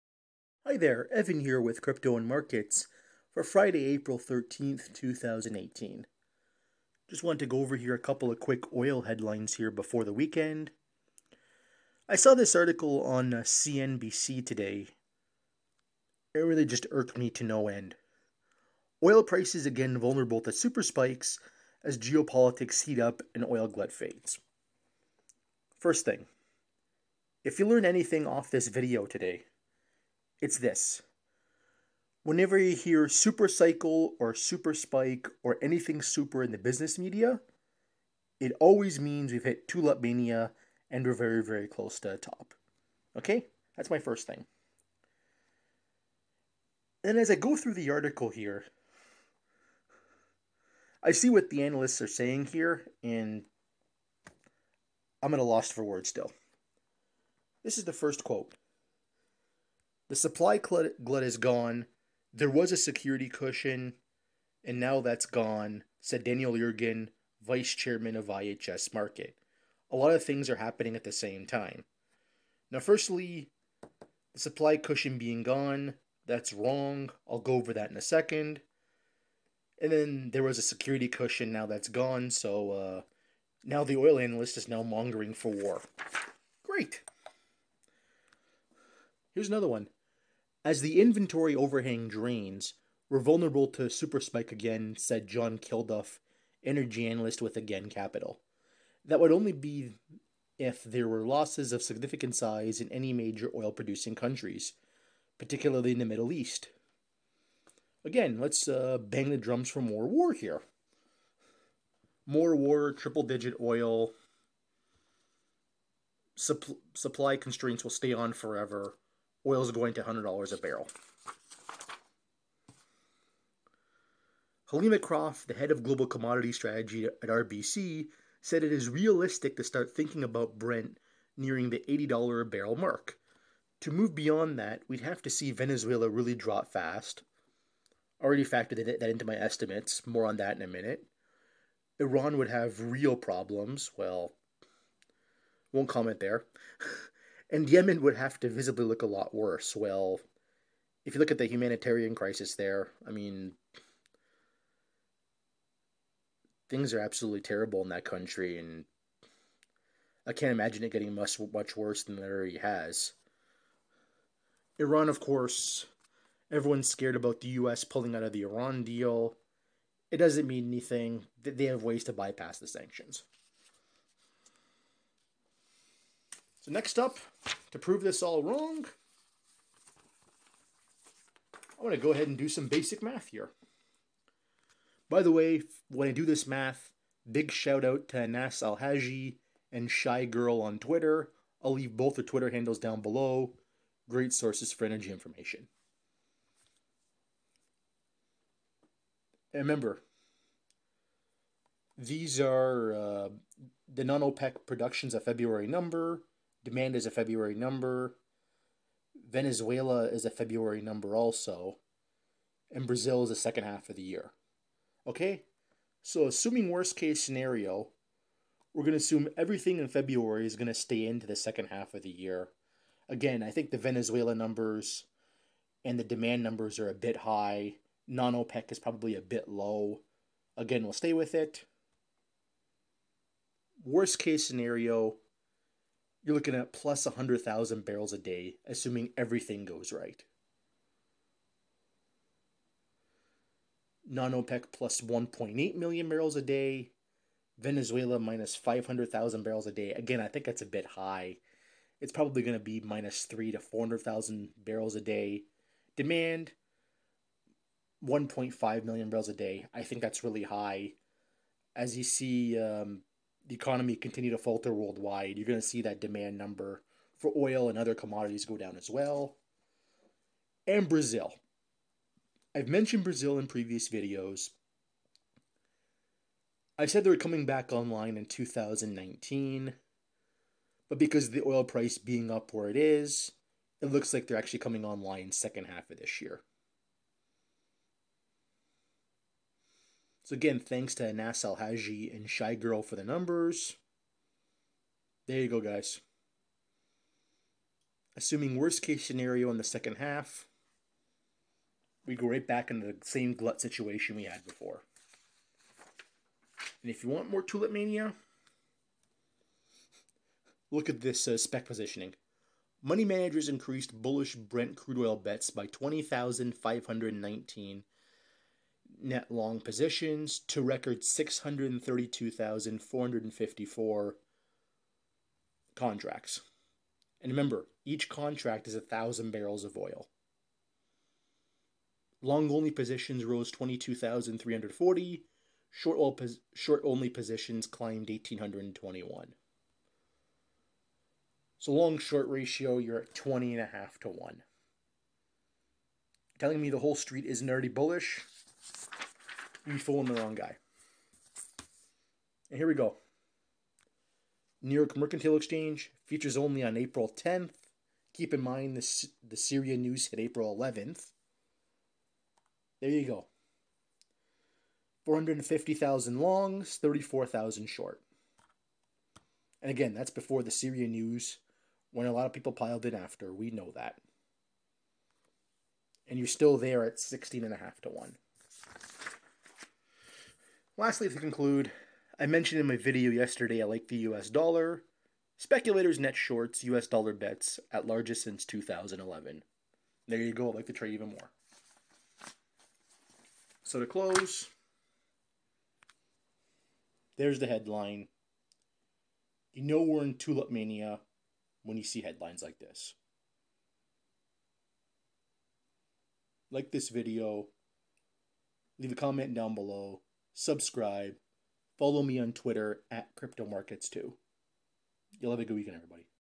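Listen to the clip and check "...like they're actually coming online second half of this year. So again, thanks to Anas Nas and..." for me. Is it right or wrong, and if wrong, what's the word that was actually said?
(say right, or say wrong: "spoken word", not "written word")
wrong: "Haji", not "Nas".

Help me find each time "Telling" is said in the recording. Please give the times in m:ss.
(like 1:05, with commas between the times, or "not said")
5:46.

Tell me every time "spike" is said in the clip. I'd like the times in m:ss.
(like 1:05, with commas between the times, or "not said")
0:20, 0:34, 1:34.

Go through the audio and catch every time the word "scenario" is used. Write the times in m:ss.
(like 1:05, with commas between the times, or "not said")
3:37, 3:54, 4:59.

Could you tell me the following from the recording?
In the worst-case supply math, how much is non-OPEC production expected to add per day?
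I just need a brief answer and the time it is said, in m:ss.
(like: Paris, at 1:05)
1.8 million barrels a day, at 4:05.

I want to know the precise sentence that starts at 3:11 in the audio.
I'll leave both their Twitter handles down below.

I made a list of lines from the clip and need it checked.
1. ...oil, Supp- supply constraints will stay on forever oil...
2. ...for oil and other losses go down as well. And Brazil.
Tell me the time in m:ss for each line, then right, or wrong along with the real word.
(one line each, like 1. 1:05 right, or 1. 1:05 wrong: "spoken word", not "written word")
1. 1:53 right
2. 4:27 wrong: "commodities", not "losses".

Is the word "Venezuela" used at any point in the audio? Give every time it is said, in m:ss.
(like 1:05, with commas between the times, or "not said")
2:15, 3:29, 3:43, 4:07.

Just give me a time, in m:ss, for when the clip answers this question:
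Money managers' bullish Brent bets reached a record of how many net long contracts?
5:21.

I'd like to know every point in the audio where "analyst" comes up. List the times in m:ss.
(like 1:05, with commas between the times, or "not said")
0:51, 1:24, 1:37.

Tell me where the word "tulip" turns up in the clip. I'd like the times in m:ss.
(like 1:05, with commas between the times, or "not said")
0:39, 5:07, 6:40.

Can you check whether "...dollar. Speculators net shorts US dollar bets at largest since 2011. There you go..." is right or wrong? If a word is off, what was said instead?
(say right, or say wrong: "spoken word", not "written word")
right.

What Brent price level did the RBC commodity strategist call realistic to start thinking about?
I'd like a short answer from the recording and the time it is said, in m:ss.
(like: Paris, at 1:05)
$80 a barrel, at 2:11.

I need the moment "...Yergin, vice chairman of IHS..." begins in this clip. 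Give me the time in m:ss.
1:06.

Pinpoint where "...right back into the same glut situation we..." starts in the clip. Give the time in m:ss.
5:02.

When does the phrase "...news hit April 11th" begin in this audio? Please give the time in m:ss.
5:59.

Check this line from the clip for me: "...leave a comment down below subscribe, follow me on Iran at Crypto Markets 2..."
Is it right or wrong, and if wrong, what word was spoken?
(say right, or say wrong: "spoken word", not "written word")
wrong: "Twitter", not "Iran".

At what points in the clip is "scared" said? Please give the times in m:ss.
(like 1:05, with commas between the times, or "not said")
2:46.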